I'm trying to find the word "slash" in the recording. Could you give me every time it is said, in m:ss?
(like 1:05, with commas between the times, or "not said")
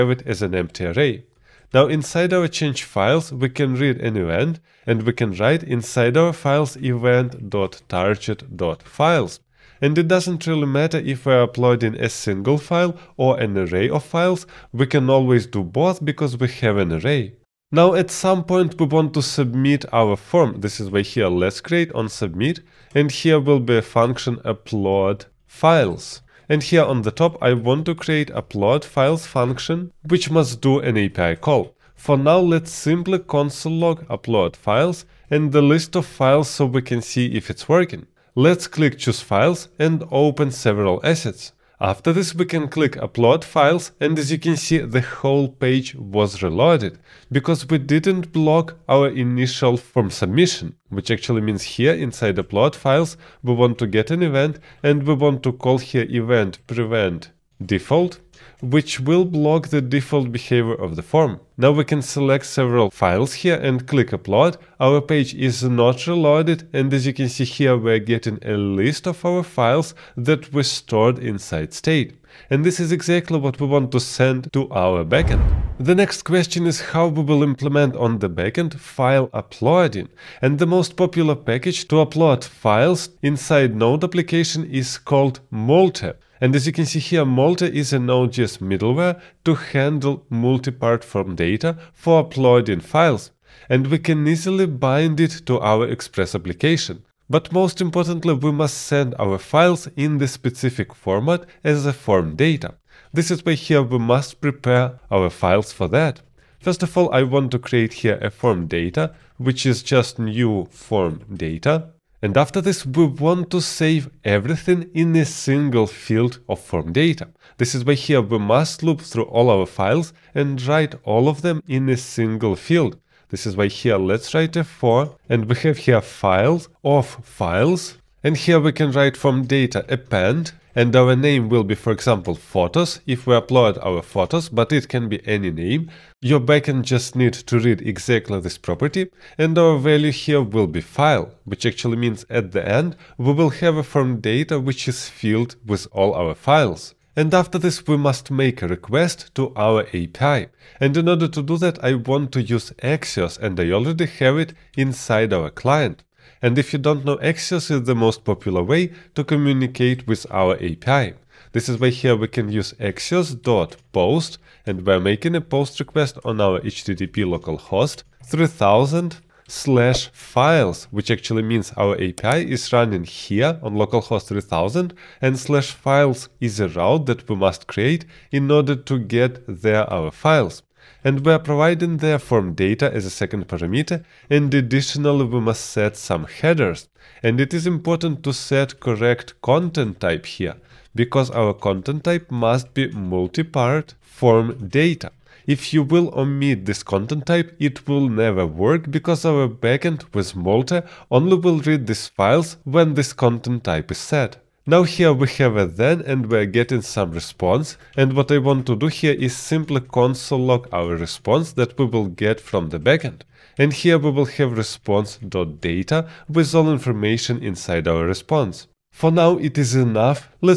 2:49, 2:55.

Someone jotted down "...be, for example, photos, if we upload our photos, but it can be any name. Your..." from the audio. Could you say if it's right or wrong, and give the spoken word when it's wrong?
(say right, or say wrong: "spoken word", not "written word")
right.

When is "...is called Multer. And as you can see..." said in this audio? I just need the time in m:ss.
1:24.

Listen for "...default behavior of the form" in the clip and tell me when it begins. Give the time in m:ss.
0:59.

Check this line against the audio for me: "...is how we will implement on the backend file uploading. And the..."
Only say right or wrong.
right.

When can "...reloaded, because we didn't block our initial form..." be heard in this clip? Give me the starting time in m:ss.
0:46.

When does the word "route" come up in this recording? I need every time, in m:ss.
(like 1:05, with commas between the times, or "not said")
2:56.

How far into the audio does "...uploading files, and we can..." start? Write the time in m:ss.
1:32.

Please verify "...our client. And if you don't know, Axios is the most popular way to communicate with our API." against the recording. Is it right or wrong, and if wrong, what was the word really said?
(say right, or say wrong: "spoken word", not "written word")
right.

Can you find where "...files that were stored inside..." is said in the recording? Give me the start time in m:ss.
1:09.